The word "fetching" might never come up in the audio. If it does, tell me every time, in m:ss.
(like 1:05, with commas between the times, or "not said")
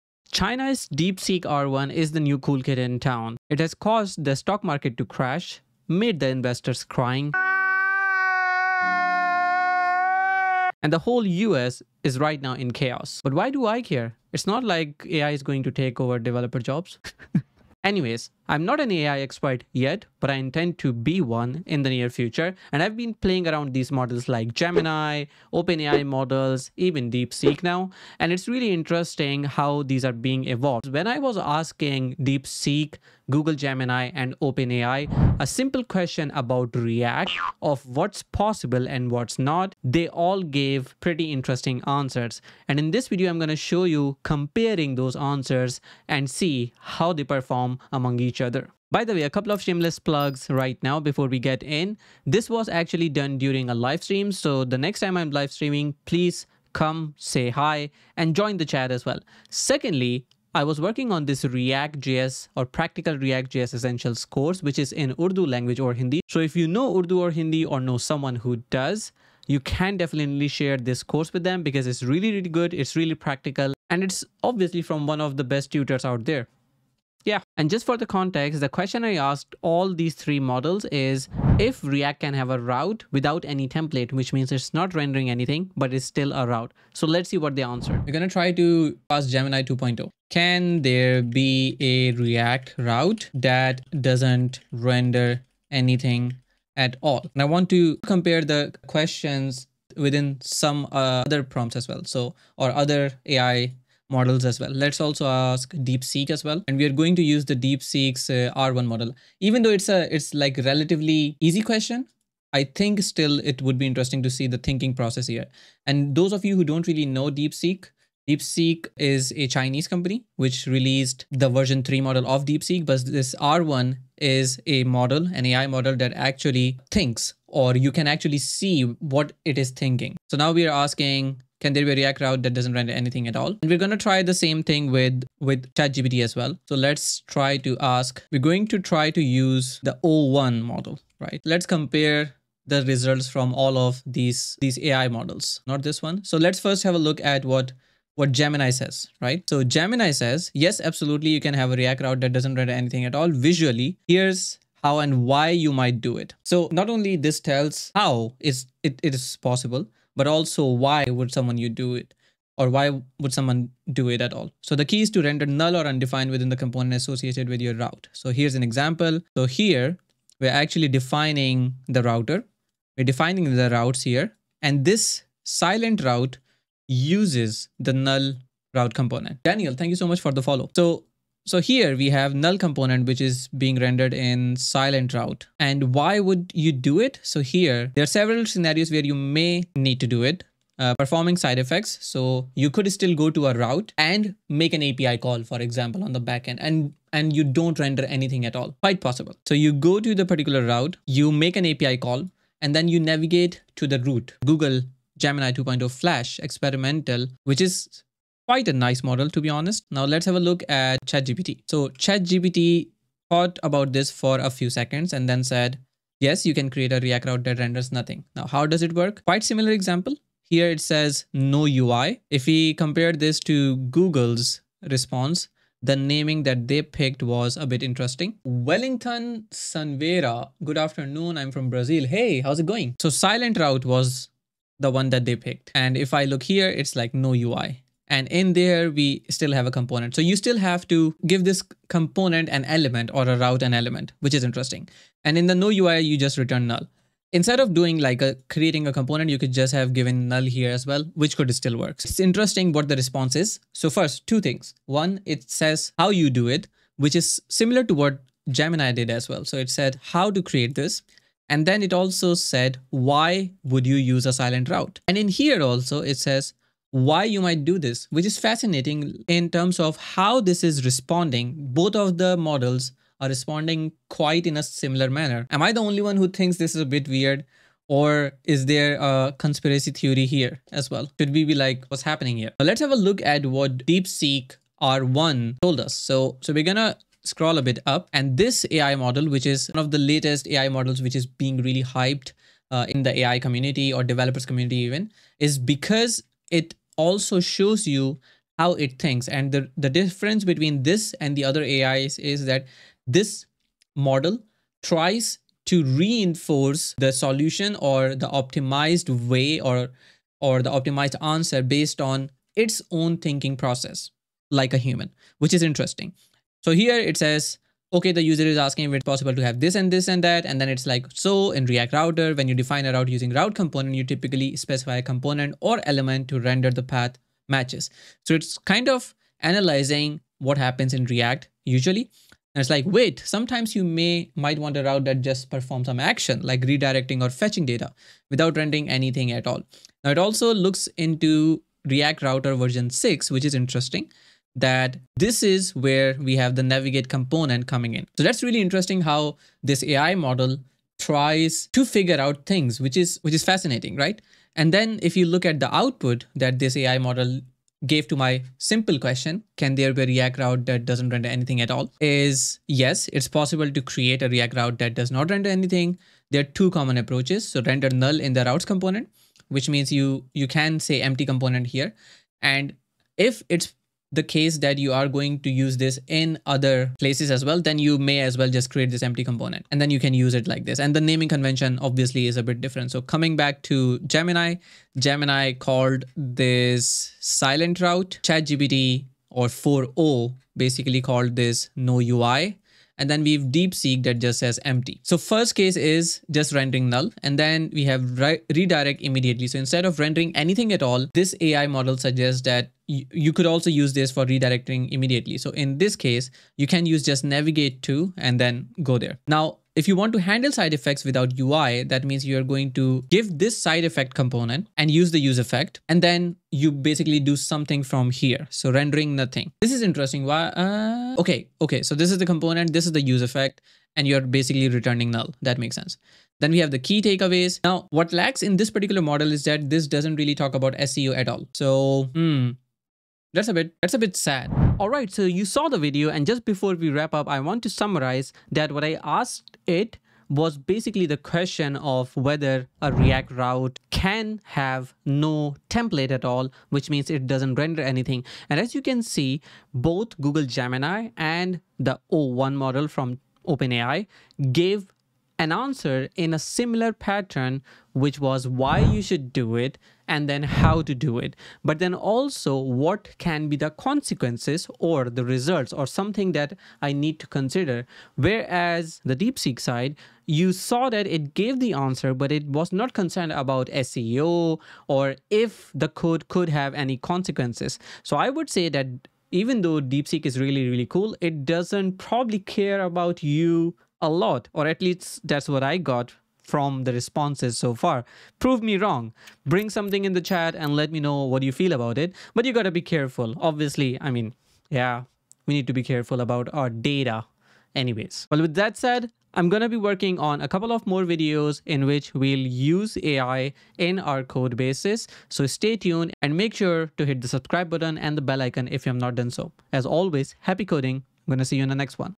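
5:37.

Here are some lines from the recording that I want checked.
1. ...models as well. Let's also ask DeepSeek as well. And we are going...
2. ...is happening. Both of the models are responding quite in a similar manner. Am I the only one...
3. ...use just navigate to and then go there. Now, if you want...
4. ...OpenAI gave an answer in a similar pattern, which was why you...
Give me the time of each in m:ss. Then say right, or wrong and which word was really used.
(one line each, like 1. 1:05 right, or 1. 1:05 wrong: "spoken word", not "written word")
1. 1:44 right
2. 4:30 wrong: "responding", not "happening"
3. 6:46 right
4. 7:33 right.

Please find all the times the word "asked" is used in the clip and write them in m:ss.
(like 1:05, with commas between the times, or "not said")
1:19, 7:19.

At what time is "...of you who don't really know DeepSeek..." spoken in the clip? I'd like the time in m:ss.
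1:56.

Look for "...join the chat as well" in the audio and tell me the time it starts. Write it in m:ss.
0:58.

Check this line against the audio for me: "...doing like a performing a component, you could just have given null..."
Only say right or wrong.
wrong.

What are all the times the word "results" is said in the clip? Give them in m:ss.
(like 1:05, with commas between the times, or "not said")
2:22, 7:45.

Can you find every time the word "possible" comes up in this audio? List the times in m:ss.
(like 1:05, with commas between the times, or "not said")
0:38, 2:39, 3:18, 5:19, 6:03.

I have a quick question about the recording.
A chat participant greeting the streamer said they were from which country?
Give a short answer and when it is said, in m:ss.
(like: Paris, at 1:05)
Brazil, at 3:51.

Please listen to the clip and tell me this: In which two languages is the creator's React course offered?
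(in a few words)
Urdu or Hindi.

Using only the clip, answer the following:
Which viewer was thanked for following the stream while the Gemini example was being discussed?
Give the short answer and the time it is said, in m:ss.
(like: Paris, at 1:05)
Daniel, at 2:59.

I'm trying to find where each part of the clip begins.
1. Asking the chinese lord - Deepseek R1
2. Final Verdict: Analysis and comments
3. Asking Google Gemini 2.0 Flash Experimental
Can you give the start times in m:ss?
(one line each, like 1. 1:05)
1. 4:41
2. 7:16
3. 1:28.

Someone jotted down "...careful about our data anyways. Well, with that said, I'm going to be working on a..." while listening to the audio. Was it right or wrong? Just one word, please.
right.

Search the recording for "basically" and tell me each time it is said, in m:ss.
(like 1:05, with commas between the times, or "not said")
6:30, 6:56, 7:04, 7:20.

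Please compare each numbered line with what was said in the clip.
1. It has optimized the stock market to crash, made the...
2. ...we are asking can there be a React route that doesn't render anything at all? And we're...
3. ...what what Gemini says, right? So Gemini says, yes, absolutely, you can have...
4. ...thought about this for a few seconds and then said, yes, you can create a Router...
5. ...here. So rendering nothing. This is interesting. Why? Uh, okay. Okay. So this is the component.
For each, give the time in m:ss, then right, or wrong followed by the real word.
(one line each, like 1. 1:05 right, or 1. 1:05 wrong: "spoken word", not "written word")
1. 0:03 wrong: "caused", not "optimized"
2. 2:10 right
3. 2:27 right
4. 3:33 wrong: "React", not "Router"
5. 6:58 right.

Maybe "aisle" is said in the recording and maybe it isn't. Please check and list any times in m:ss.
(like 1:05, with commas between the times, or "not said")
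not said.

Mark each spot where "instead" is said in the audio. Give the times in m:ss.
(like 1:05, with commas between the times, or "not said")
4:07, 6:39.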